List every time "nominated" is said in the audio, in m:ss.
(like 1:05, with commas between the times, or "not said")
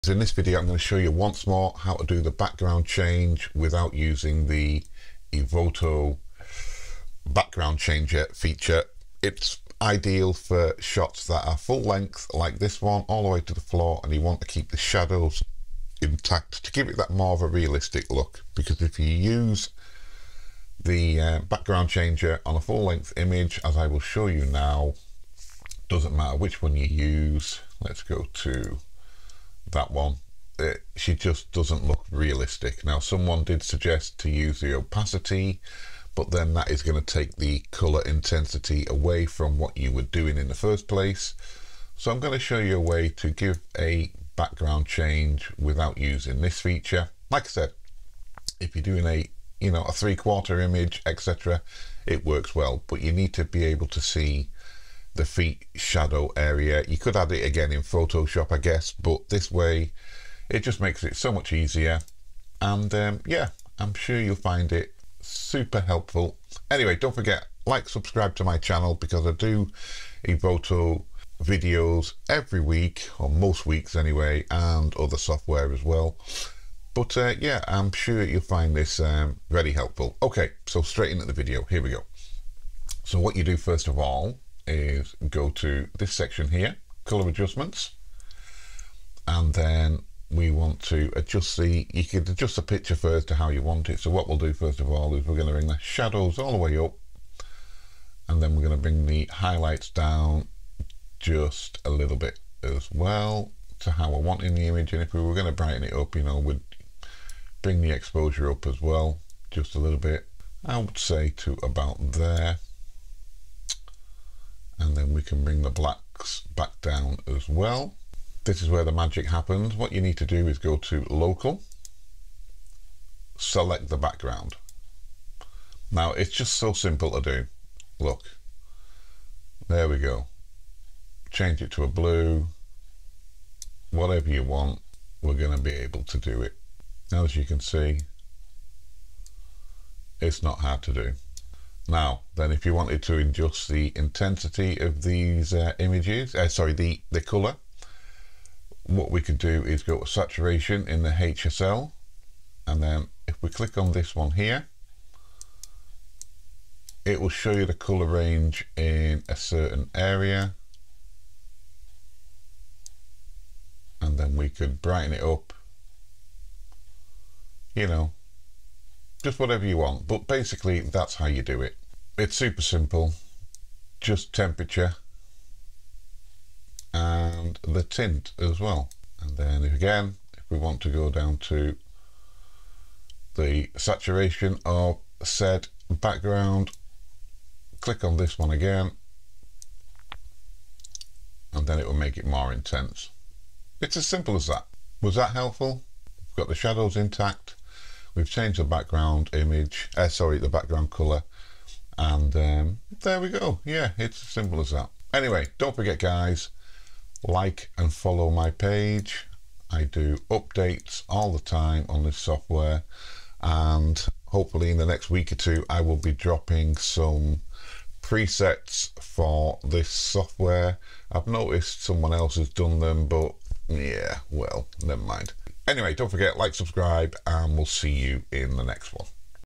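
not said.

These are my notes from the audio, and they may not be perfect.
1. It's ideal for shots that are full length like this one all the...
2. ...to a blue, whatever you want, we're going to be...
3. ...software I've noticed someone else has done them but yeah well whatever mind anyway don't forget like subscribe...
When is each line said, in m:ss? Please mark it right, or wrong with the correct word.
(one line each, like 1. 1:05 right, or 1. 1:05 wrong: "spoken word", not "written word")
1. 0:09 right
2. 2:11 right
3. 3:39 wrong: "never", not "whatever".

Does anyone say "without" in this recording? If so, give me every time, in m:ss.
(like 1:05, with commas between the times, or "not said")
0:03, 0:45.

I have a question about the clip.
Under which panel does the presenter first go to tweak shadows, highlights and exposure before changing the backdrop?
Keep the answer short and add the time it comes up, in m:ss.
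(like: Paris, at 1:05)
Color adjustments, at 1:27.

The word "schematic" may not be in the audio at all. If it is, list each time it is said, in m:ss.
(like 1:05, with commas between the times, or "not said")
not said.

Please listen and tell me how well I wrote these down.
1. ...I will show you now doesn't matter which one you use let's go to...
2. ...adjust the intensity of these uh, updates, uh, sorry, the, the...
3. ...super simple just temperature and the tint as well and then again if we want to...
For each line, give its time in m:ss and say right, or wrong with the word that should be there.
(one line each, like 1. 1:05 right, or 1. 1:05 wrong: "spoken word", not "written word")
1. 0:23 right
2. 2:23 wrong: "images", not "updates"
3. 2:52 right.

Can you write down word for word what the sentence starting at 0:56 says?
You could add it again in Photoshop, I guess, but this way it just makes it so much easier.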